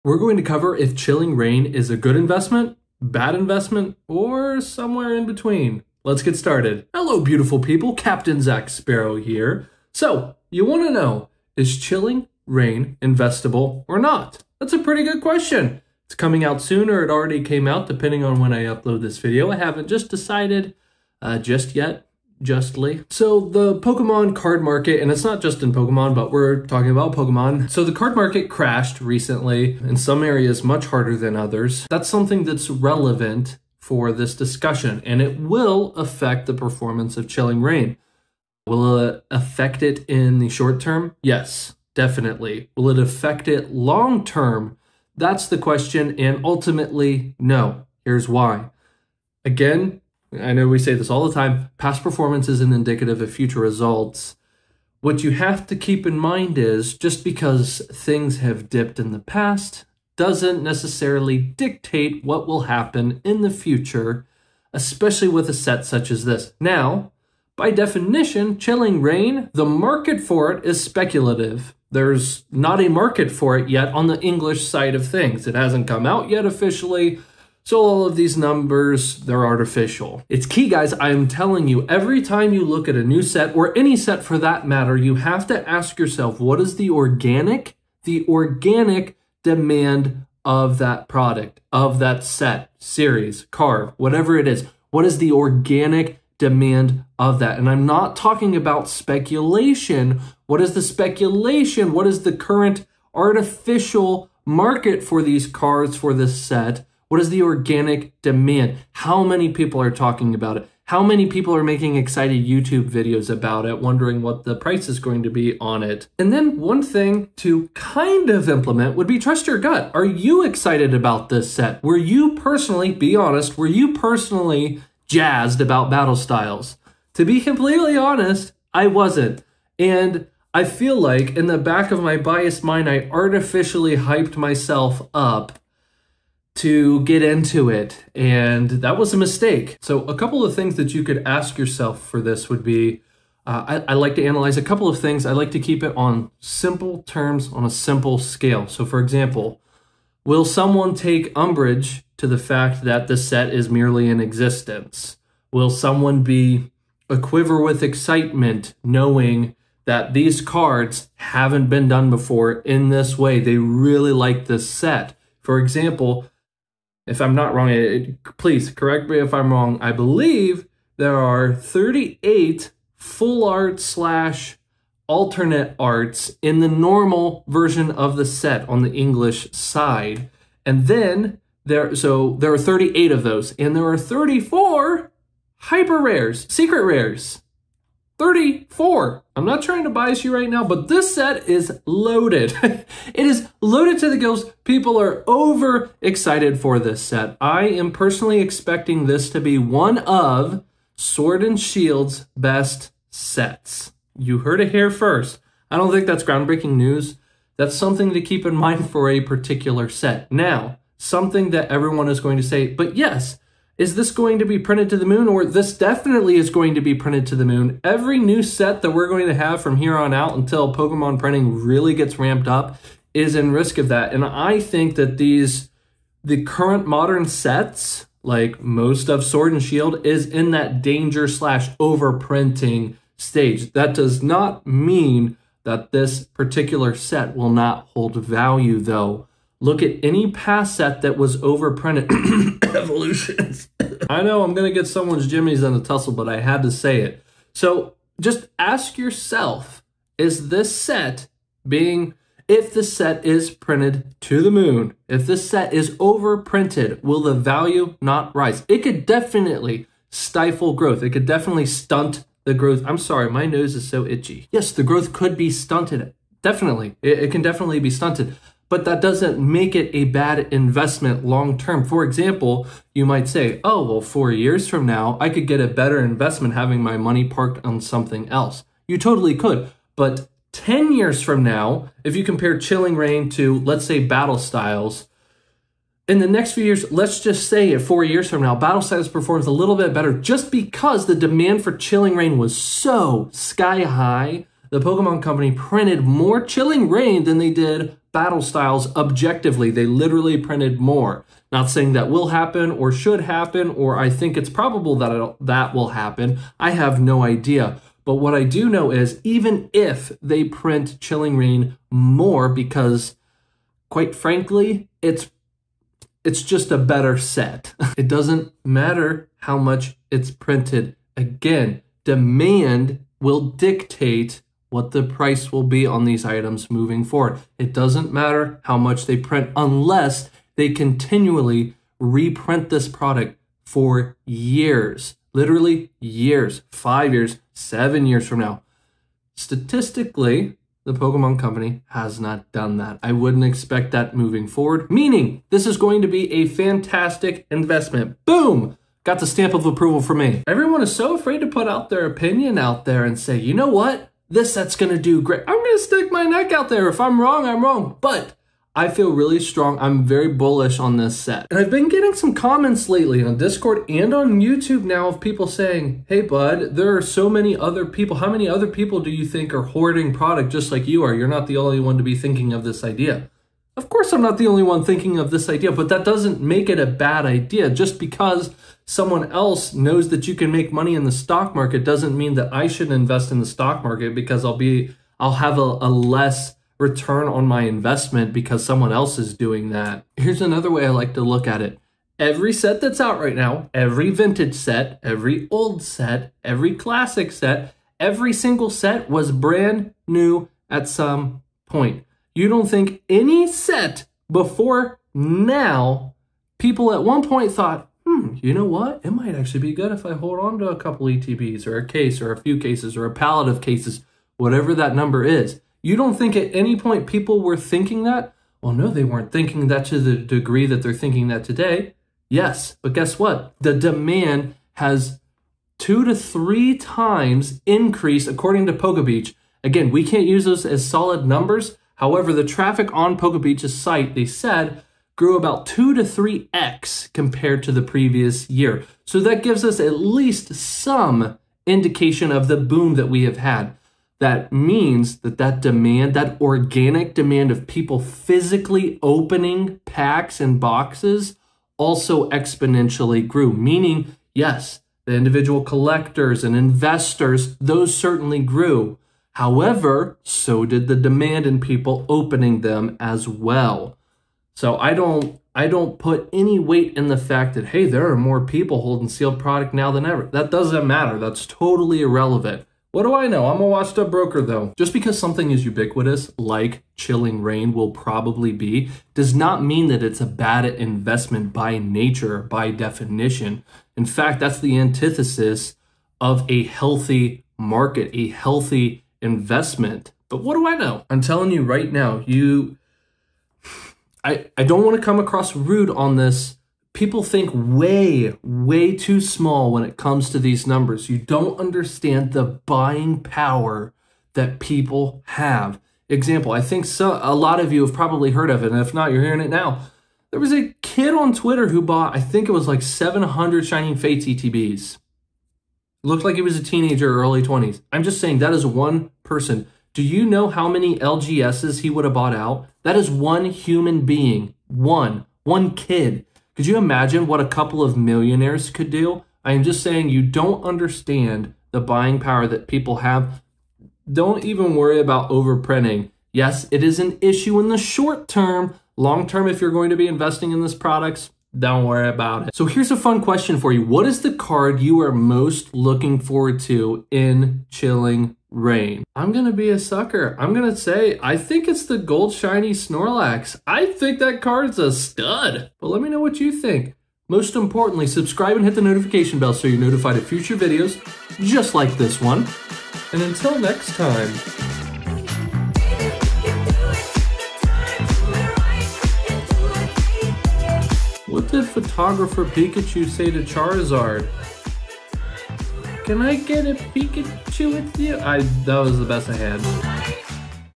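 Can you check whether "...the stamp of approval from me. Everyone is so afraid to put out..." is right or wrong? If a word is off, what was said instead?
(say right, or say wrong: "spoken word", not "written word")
right.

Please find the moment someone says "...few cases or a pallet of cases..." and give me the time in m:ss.
6:52.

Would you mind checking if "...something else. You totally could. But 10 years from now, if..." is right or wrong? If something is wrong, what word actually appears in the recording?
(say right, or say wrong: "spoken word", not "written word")
right.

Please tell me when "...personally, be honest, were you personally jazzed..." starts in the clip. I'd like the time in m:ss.
2:02.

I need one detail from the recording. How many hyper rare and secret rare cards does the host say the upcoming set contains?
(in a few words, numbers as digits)
34.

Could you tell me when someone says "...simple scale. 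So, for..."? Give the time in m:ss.
2:27.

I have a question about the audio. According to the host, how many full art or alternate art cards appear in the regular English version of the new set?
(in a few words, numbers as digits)
38.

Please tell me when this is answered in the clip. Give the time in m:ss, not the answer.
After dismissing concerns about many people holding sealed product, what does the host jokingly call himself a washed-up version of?
7:53.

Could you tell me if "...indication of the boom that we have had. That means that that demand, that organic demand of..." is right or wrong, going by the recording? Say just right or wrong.
right.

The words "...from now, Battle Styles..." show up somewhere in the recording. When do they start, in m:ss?
4:48.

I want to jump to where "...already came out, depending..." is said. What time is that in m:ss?
0:17.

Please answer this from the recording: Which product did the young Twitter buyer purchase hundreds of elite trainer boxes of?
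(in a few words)
Shining Fates.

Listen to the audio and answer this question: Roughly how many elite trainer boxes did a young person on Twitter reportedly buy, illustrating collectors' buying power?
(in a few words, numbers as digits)
700.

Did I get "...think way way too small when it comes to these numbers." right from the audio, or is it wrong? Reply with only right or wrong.
right.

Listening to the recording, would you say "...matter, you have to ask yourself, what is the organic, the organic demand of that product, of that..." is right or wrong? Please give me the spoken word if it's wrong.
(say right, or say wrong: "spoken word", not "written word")
right.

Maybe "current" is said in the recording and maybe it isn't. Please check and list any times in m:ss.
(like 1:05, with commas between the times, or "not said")
1:42, 3:46.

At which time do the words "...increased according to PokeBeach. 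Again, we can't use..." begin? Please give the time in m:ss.
7:07.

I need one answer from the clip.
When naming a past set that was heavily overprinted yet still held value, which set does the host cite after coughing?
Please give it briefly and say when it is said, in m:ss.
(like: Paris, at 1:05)
Evolutions, at 4:02.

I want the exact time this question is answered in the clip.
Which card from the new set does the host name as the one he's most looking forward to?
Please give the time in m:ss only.
9:11.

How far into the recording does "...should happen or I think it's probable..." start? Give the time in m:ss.
5:02.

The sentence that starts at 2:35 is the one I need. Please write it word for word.
Will someone be a quiver with excitement knowing that these cards haven't been done before in this way?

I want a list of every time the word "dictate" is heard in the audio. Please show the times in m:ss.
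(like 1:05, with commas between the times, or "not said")
1:01, 5:23.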